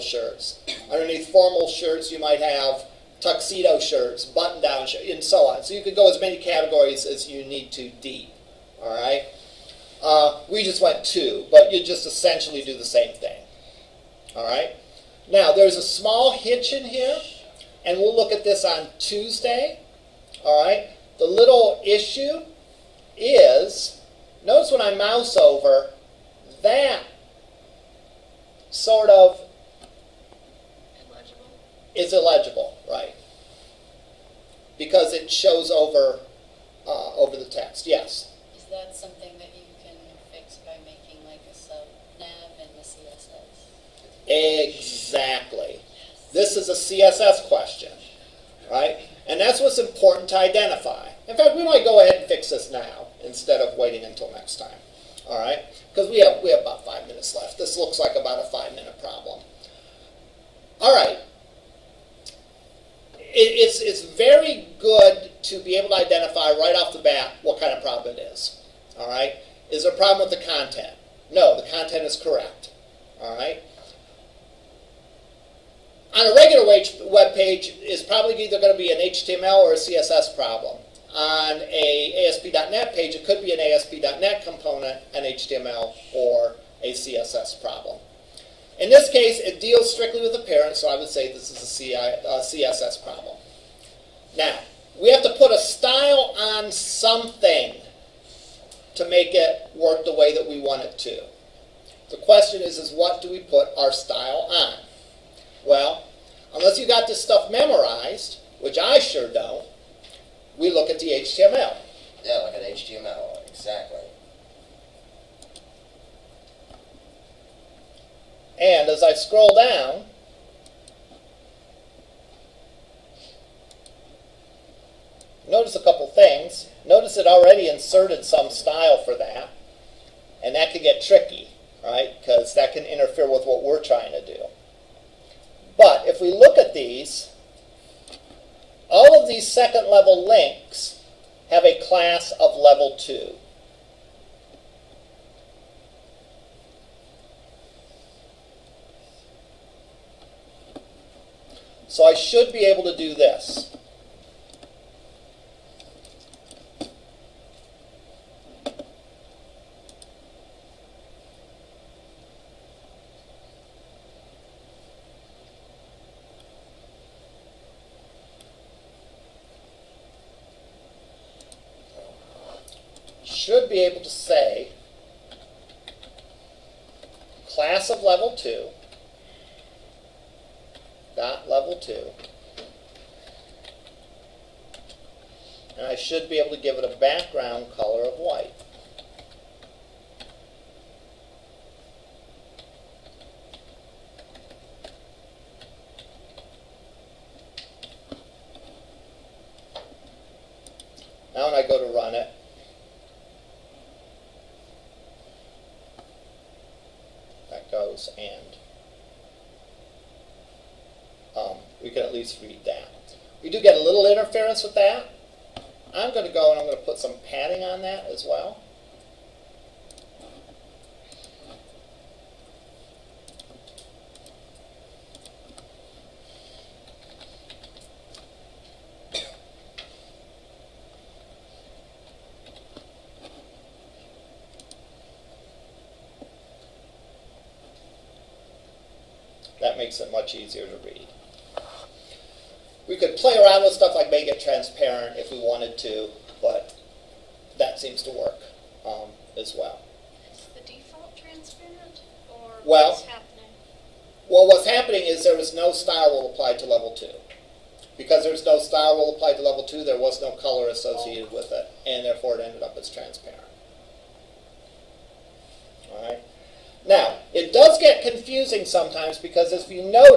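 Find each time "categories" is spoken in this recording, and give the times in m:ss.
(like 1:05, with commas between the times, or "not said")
0:06.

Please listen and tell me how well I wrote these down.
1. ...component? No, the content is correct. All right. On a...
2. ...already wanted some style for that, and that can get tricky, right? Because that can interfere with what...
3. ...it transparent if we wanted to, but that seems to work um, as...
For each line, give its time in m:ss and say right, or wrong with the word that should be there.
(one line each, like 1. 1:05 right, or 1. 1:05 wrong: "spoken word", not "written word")
1. 1:10 wrong: "content", not "component"
2. 2:07 wrong: "inserted", not "wanted"
3. 4:04 right.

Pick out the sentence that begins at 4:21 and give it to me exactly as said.
with it, and therefore it ended up as transparent.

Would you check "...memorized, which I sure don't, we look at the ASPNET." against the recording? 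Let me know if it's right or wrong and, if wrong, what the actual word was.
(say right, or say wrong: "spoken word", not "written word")
wrong: "HTML", not "ASPNET".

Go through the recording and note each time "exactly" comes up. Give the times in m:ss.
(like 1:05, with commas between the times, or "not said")
0:44, 1:53.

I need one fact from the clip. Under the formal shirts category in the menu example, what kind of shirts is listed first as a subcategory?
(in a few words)
tuxedo shirts.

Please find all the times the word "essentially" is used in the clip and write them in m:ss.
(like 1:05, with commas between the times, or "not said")
0:12.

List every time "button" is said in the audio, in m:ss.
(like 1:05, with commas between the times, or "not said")
0:04.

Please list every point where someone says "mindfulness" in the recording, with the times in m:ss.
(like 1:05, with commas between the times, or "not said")
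not said.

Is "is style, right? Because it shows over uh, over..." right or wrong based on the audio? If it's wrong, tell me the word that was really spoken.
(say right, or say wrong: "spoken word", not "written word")
wrong: "illegible", not "style".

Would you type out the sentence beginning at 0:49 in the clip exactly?
And that's what's important to identify.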